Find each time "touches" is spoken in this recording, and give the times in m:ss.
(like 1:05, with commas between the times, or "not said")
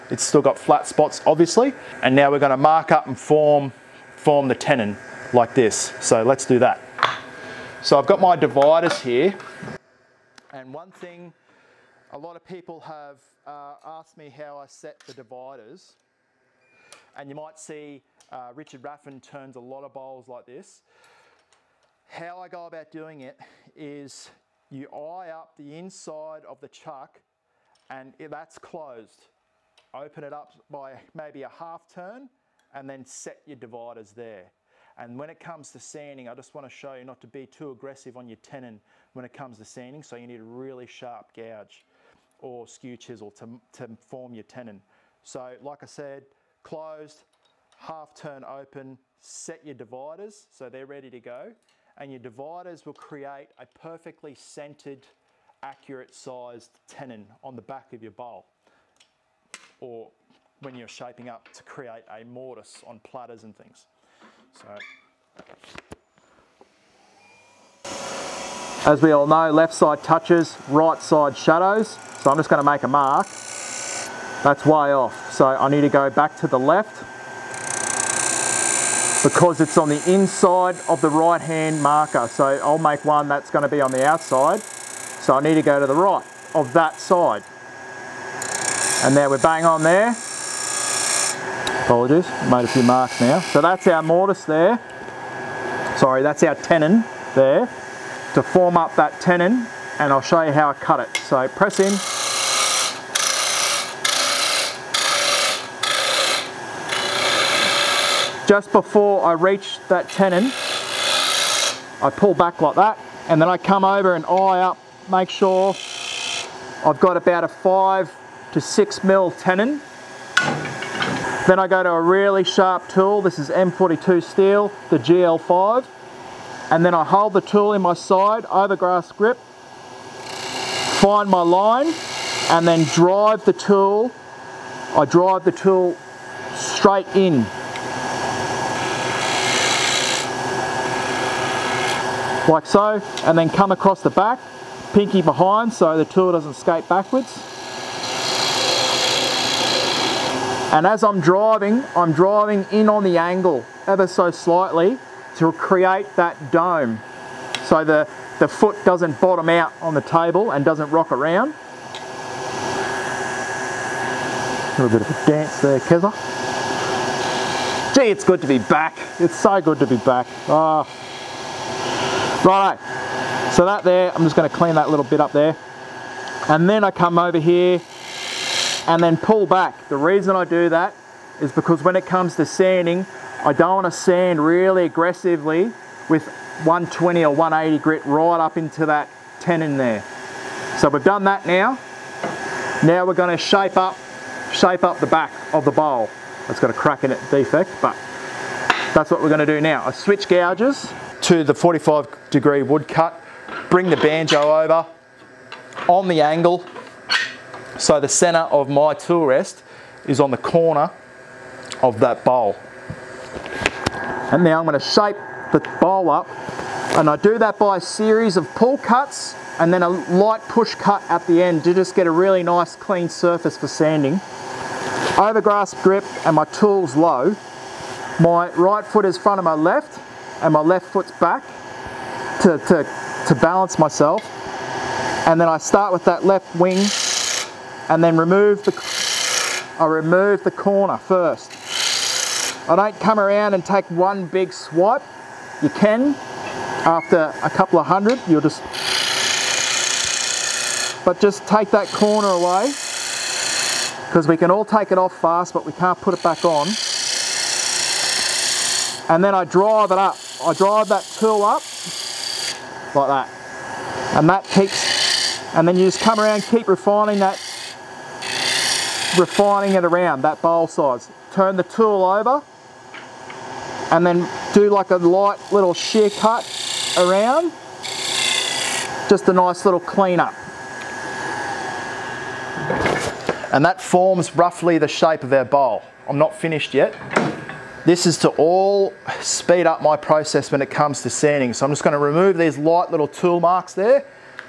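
1:10.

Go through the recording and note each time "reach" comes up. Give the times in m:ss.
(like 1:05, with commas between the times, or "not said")
1:49.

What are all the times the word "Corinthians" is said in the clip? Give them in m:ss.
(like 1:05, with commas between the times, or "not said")
not said.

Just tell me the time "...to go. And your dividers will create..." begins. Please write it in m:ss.
0:51.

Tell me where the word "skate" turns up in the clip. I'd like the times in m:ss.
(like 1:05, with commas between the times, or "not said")
2:26.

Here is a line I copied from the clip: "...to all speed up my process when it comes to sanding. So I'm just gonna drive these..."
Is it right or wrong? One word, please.
wrong.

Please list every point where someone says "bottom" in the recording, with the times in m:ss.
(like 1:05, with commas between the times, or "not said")
2:39.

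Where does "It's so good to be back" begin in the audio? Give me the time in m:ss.
2:49.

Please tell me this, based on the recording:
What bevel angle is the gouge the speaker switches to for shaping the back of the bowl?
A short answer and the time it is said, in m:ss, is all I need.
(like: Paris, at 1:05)
45 degree, at 3:21.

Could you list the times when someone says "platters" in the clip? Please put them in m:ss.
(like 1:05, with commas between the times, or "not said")
1:02.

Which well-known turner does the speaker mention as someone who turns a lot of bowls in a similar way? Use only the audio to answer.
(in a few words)
Richard Raffan.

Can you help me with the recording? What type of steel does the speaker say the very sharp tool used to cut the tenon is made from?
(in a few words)
M42.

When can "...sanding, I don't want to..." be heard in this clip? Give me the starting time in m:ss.
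3:02.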